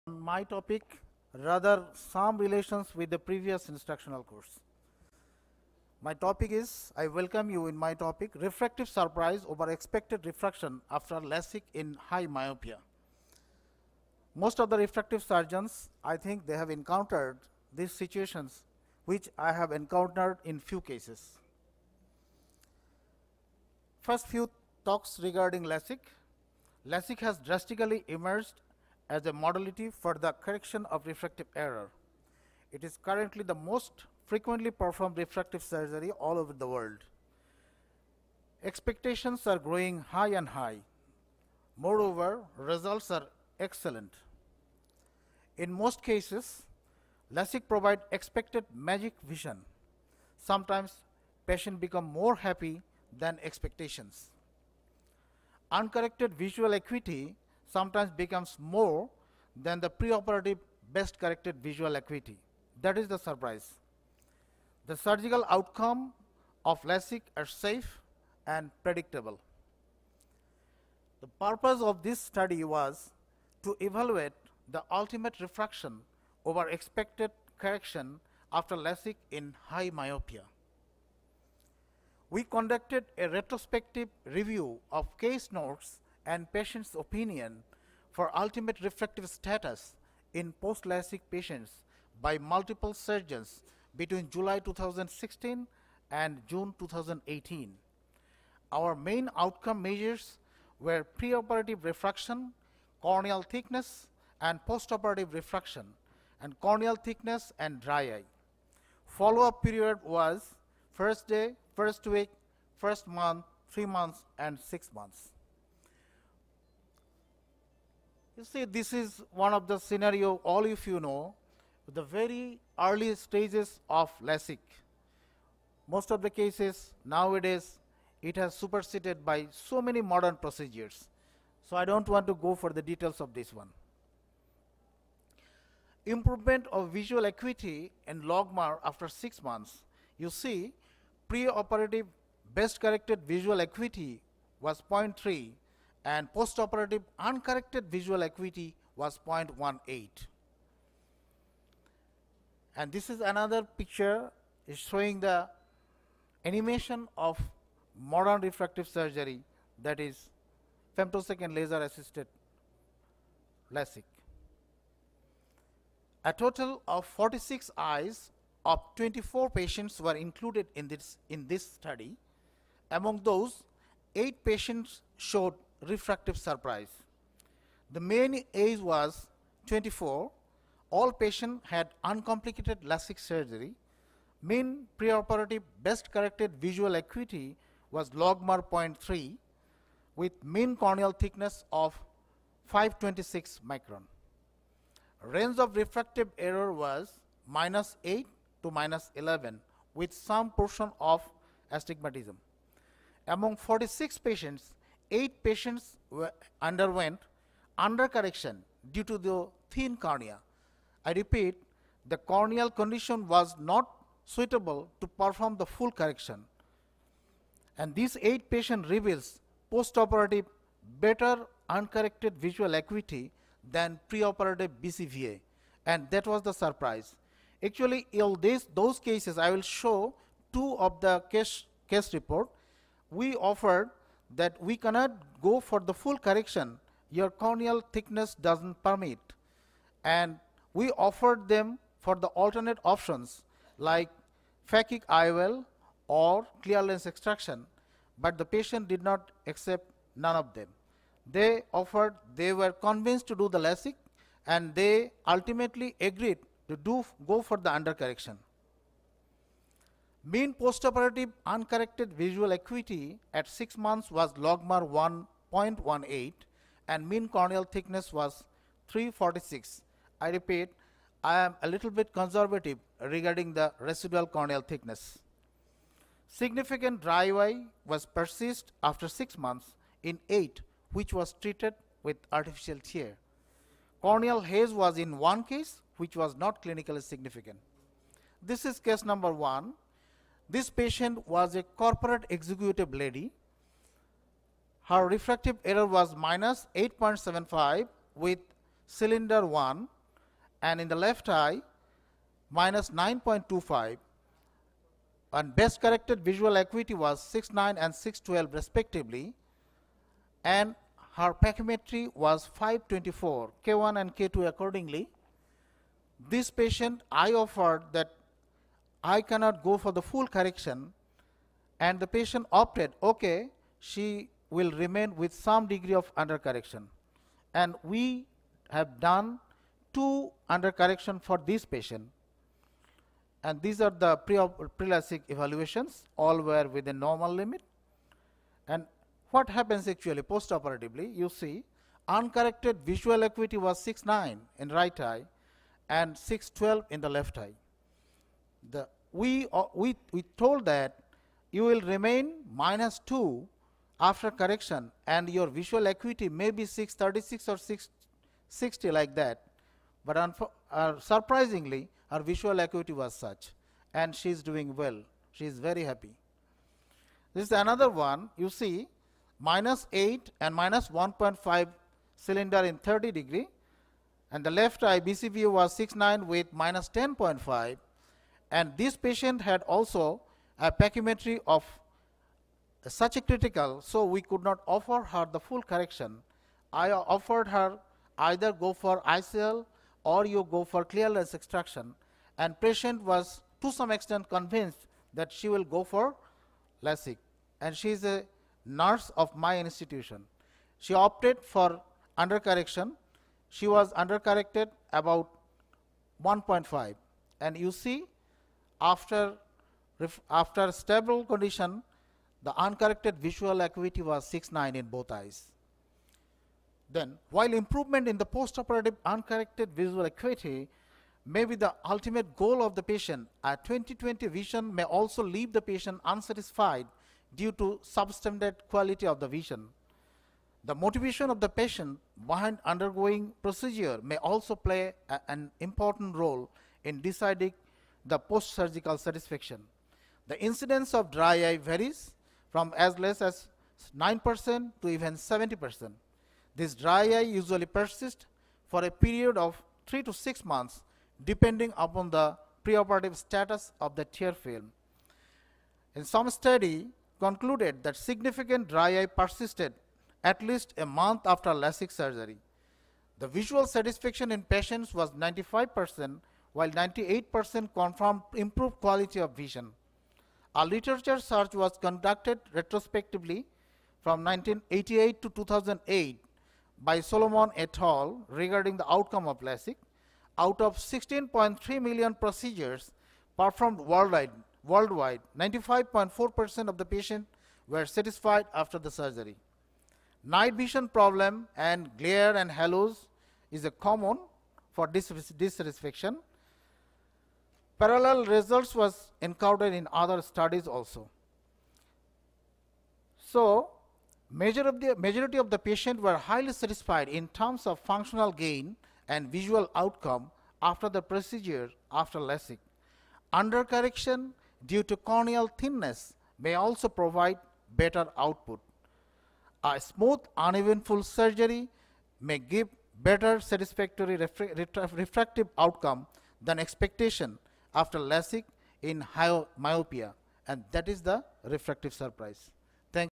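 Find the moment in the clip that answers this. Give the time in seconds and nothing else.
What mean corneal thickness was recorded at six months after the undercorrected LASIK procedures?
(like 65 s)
268 s.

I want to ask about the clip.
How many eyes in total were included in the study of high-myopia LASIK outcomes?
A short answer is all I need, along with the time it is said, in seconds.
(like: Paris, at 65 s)
46, at 167 s.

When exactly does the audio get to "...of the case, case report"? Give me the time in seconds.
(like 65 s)
230 s.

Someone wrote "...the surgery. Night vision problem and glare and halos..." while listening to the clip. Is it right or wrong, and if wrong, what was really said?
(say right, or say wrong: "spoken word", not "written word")
right.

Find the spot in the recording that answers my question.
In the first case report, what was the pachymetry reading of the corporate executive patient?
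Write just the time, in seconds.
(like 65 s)
312 s.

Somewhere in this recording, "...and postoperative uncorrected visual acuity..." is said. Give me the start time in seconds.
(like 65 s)
146 s.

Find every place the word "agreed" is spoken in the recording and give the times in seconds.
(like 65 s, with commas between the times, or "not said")
256 s.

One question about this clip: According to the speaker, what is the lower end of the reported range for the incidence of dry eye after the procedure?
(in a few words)
9%.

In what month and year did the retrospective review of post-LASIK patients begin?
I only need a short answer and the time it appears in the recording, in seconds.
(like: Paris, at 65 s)
July 2016, at 94 s.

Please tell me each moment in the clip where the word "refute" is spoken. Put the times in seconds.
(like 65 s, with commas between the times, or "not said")
not said.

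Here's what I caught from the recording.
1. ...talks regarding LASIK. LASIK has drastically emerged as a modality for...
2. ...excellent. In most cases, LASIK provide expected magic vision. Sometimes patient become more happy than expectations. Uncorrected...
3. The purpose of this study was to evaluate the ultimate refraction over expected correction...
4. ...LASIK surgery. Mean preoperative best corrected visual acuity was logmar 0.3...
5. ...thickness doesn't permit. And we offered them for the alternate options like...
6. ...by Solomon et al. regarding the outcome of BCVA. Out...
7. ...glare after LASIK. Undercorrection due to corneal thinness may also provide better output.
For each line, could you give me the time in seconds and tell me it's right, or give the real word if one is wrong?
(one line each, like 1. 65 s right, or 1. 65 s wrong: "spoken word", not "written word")
1. 24 s right
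2. 43 s right
3. 71 s right
4. 182 s right
5. 237 s right
6. 476 s wrong: "LASIK", not "BCVA"
7. 511 s wrong: "procedure", not "glare".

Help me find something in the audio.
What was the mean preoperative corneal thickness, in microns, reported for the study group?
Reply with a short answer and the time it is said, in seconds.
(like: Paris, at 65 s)
526, at 192 s.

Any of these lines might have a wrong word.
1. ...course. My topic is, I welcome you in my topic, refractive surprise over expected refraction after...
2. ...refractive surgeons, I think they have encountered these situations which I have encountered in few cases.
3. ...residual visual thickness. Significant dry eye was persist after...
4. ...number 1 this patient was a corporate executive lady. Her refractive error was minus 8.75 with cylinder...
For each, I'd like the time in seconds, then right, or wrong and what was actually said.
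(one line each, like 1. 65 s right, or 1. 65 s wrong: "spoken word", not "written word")
1. 4 s right
2. 14 s right
3. 273 s wrong: "corneal", not "visual"
4. 289 s right.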